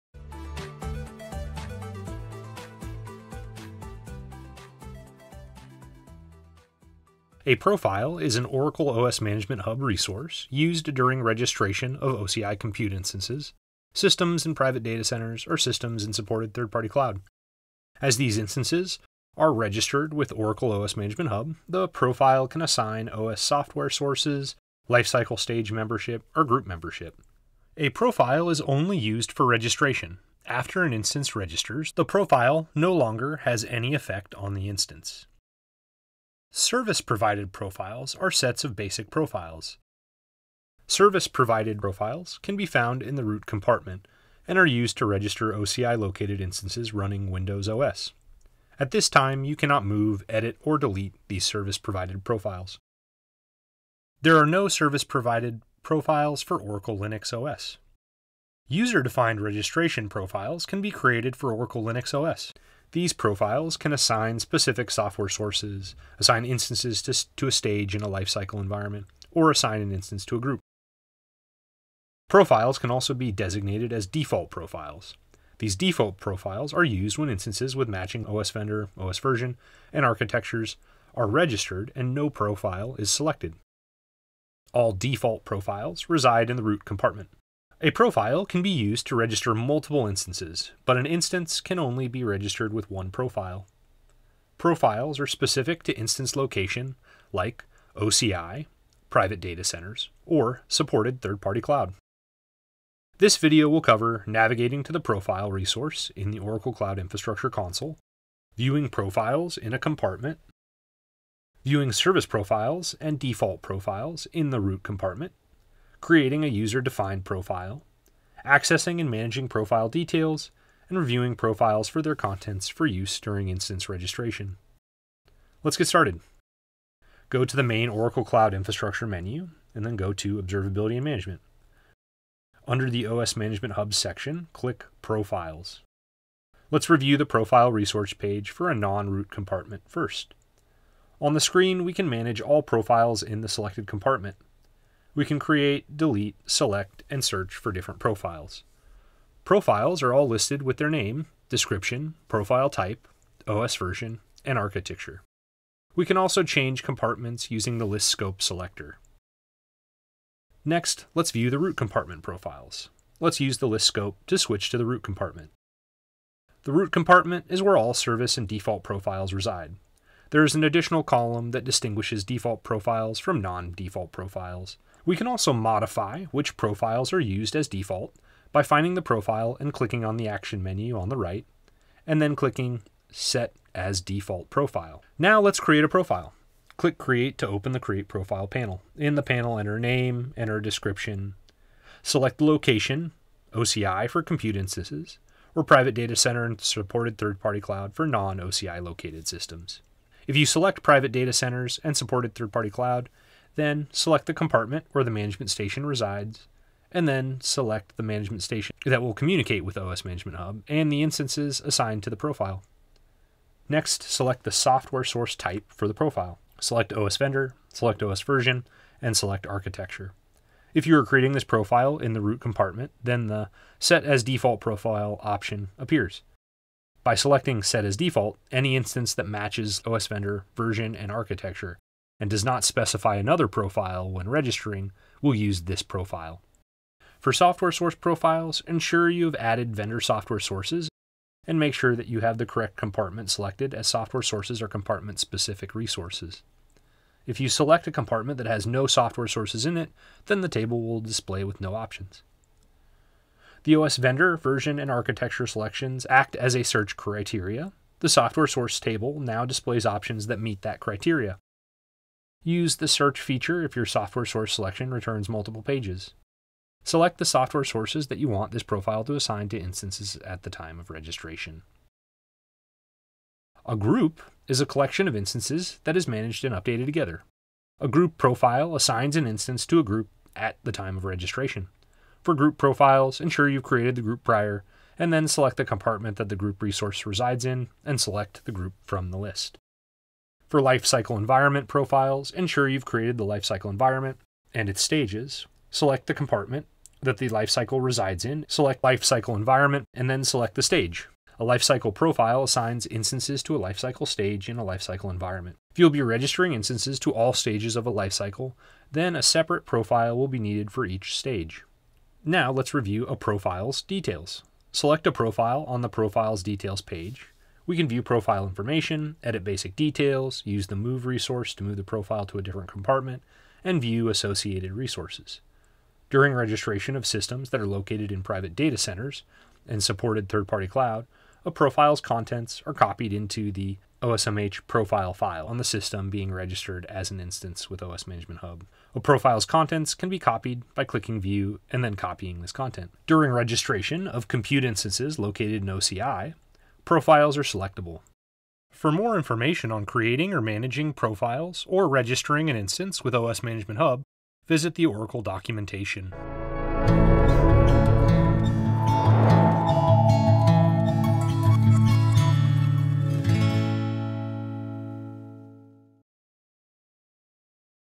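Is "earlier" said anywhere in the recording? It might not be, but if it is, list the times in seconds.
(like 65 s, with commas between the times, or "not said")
not said.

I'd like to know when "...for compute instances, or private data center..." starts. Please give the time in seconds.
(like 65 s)
194 s.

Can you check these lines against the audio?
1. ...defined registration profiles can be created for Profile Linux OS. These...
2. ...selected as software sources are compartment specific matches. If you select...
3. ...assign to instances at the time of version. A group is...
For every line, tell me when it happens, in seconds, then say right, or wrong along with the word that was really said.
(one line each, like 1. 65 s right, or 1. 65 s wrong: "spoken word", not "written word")
1. 59 s wrong: "Oracle", not "Profile"
2. 243 s wrong: "resources", not "matches"
3. 269 s wrong: "registration", not "version".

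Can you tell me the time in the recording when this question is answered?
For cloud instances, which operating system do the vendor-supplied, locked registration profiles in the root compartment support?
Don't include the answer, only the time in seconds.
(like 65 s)
47 s.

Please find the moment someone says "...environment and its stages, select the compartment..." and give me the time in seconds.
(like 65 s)
293 s.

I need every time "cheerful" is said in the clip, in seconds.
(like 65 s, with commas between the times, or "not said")
not said.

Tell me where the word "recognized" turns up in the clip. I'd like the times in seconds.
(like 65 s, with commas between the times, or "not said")
not said.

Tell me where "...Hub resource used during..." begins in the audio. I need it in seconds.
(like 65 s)
9 s.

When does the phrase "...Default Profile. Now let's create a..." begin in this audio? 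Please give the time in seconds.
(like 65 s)
183 s.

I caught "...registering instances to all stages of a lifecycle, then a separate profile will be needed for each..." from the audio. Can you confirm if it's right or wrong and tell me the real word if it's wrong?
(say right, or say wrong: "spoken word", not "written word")
right.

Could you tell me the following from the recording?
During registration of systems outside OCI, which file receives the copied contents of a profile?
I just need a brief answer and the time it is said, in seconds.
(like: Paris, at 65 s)
OSMH profile file, at 334 s.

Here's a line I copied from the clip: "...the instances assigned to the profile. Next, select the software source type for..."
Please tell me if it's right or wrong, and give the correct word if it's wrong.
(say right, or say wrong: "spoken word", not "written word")
right.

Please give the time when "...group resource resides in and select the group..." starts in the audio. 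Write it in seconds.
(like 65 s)
286 s.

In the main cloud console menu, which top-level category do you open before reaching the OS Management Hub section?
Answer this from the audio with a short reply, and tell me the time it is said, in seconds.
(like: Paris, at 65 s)
Observability and Management, at 130 s.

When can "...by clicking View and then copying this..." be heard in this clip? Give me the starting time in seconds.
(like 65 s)
340 s.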